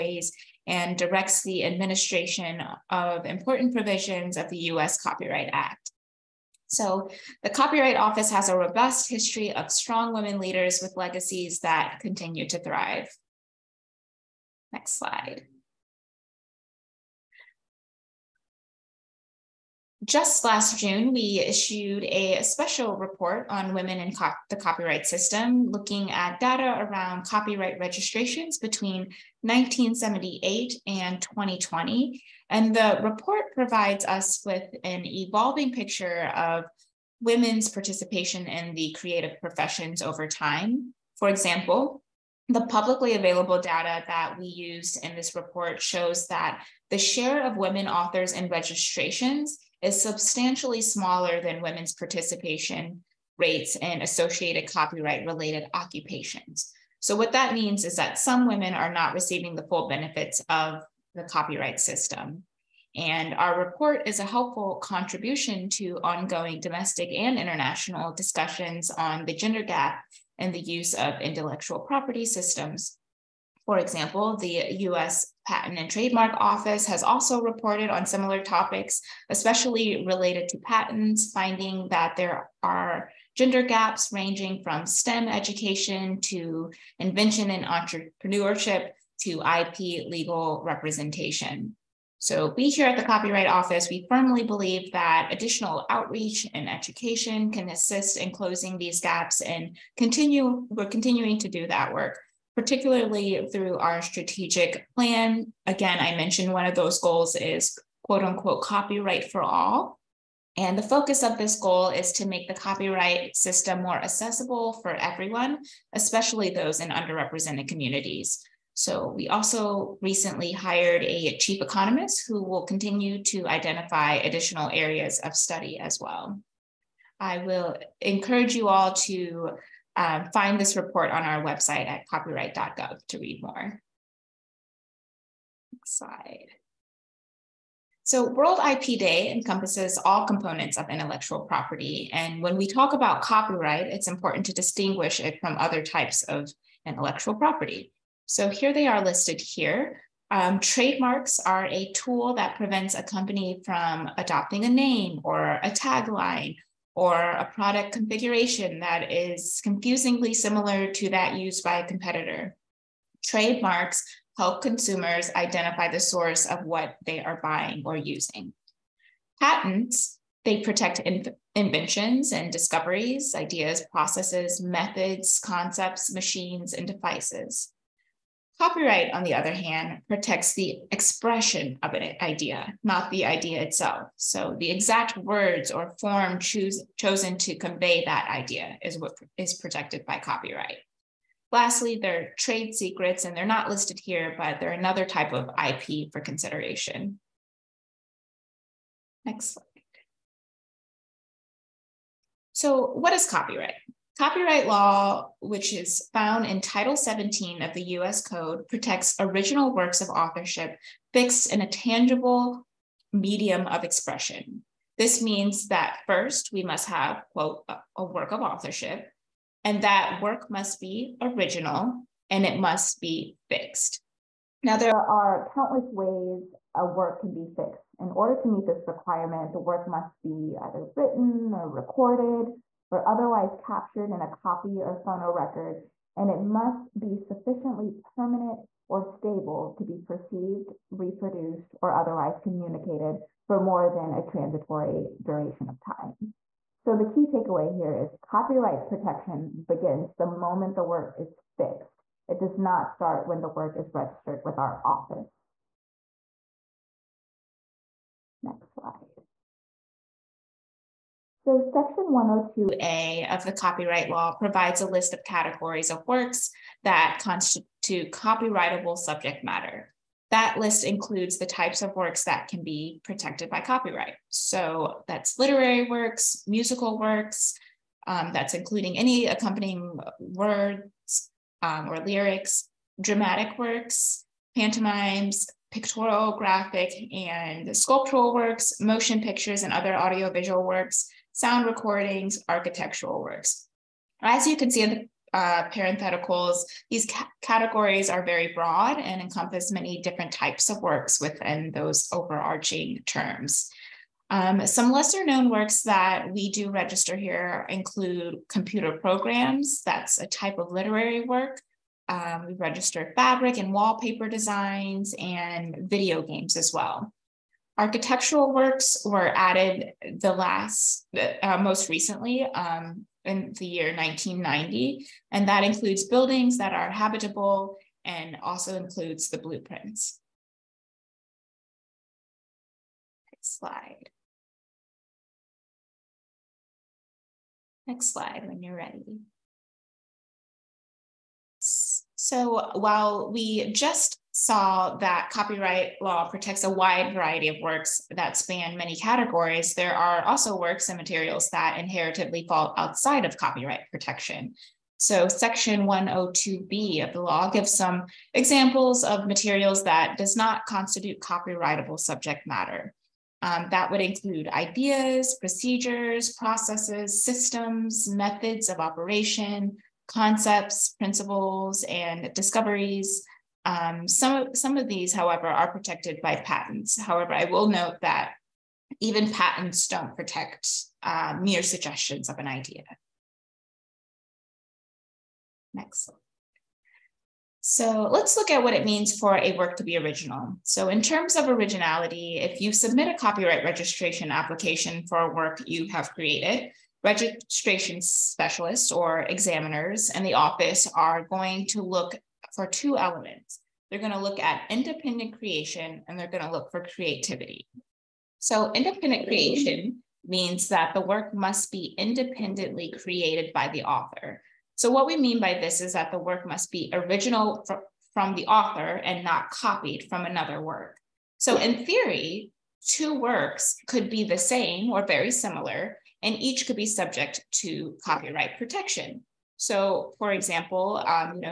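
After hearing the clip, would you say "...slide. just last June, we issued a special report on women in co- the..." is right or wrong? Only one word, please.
right.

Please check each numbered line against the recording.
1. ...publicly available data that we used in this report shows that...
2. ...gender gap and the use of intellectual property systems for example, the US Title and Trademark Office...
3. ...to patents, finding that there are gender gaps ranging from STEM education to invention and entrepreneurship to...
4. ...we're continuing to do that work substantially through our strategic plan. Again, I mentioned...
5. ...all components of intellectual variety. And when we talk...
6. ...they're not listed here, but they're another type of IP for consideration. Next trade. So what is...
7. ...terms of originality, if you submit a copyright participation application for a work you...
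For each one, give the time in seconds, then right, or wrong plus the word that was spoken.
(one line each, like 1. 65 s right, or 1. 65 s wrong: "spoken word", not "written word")
1. 42 s right
2. 69 s wrong: "Patent", not "Title"
3. 80 s right
4. 100 s wrong: "particularly", not "substantially"
5. 140 s wrong: "property", not "variety"
6. 193 s wrong: "slide", not "trade"
7. 391 s wrong: "registration", not "participation".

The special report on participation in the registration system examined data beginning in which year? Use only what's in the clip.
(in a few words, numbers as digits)
1978.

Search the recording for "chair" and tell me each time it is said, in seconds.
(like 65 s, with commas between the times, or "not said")
not said.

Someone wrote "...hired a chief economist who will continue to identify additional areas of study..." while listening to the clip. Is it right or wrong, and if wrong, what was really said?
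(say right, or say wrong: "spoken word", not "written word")
right.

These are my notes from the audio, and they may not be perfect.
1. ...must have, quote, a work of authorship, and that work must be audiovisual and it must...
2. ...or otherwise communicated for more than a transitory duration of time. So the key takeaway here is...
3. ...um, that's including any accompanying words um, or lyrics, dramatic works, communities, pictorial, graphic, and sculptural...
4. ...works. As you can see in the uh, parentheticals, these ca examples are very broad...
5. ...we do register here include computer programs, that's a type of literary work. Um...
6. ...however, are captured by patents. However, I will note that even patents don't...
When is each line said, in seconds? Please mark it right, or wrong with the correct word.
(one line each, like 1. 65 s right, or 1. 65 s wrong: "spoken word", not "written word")
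1. 216 s wrong: "original", not "audiovisual"
2. 241 s right
3. 278 s wrong: "pantomimes", not "communities"
4. 293 s wrong: "categories", not "examples"
5. 306 s right
6. 375 s wrong: "protected", not "captured".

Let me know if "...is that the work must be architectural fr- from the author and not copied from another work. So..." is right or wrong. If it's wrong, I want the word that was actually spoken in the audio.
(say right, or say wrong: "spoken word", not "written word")
wrong: "original", not "architectural".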